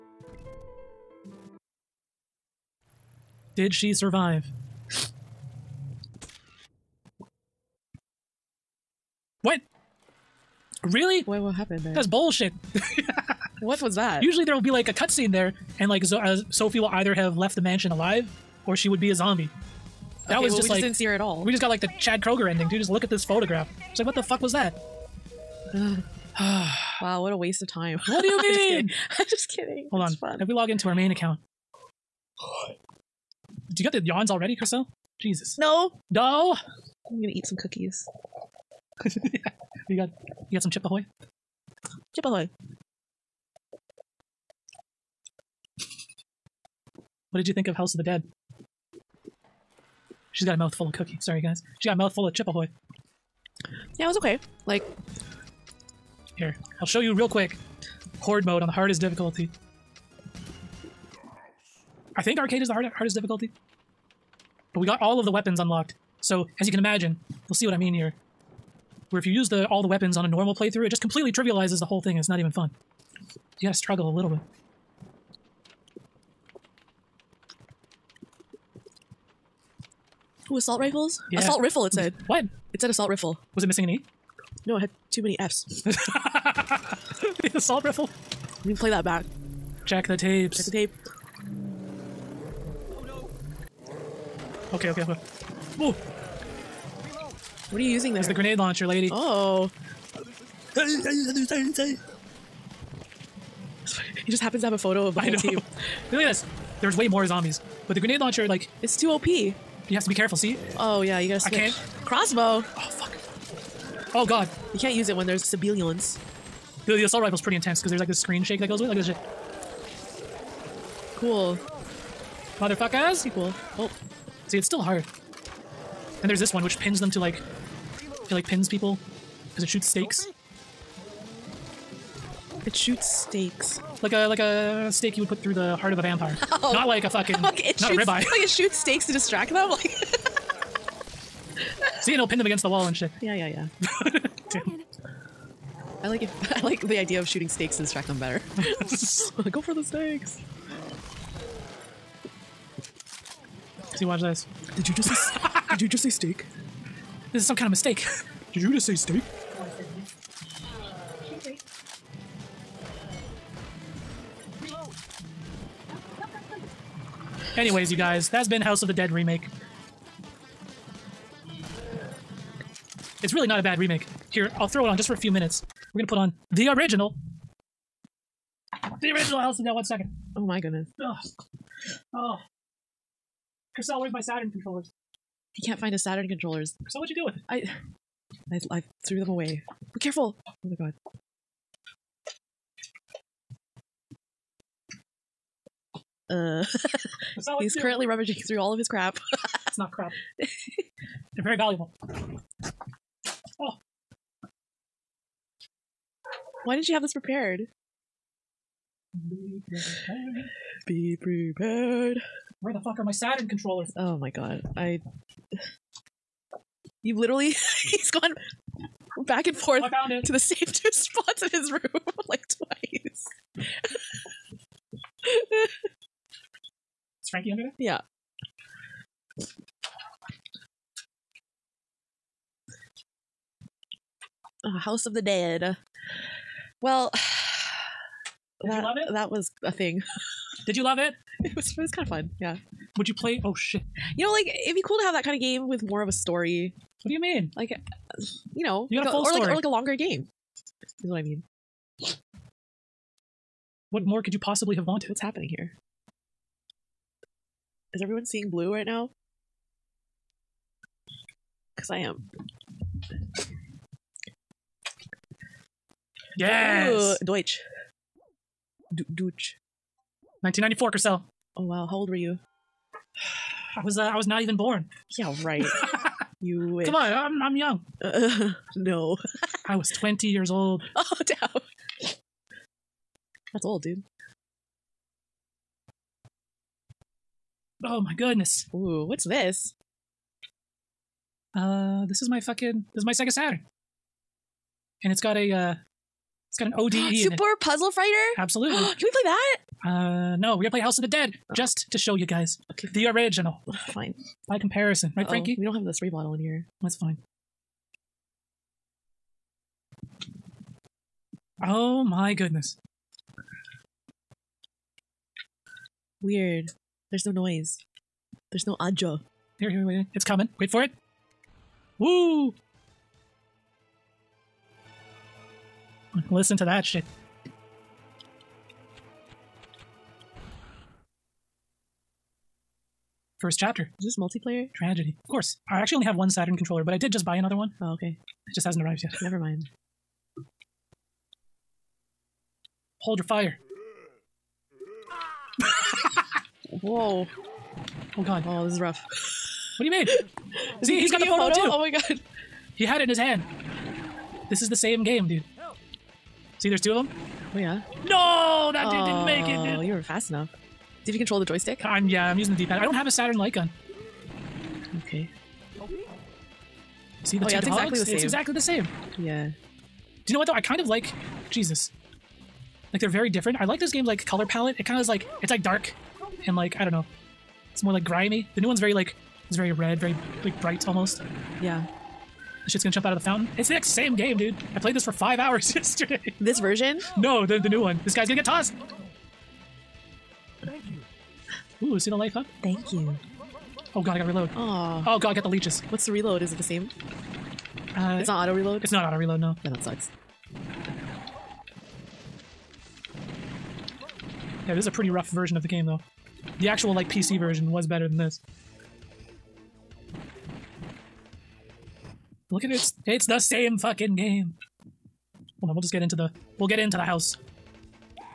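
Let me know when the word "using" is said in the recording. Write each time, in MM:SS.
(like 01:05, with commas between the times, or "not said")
01:37, 06:02.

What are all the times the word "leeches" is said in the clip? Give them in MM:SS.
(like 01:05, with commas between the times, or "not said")
06:35.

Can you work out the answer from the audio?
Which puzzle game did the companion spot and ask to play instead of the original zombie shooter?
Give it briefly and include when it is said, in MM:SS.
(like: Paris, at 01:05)
Super Puzzle Fighter, at 04:57.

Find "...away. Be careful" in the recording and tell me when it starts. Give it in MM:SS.
03:09.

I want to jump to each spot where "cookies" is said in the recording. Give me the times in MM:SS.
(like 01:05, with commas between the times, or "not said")
00:37, 00:50.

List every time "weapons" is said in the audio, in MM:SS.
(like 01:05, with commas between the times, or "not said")
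01:05, 01:09.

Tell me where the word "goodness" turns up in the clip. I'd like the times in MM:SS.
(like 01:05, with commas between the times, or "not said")
03:00, 04:48, 05:12.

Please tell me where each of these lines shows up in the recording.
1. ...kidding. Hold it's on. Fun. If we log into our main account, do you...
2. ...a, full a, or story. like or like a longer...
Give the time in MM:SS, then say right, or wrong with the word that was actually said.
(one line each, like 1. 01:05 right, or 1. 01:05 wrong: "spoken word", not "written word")
1. 00:29 right
2. 04:09 right.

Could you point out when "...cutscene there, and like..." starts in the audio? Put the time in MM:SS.
00:14.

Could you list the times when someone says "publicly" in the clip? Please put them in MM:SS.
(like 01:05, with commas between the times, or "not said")
not said.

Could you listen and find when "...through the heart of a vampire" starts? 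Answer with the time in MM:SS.
02:15.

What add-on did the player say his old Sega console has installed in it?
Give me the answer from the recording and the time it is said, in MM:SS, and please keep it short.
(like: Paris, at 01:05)
ODE, at 04:56.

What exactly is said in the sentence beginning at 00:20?
That okay, was well, just we like just didn't see her at all.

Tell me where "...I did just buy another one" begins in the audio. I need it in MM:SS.
05:36.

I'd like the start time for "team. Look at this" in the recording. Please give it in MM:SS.
01:45.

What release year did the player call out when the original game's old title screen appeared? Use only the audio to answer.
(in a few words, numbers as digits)
1994.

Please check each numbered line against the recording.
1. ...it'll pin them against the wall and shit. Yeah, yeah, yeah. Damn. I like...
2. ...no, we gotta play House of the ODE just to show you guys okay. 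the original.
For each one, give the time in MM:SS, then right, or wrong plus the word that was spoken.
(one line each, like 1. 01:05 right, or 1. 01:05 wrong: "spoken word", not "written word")
1. 02:22 right
2. 05:00 wrong: "Dead", not "ODE".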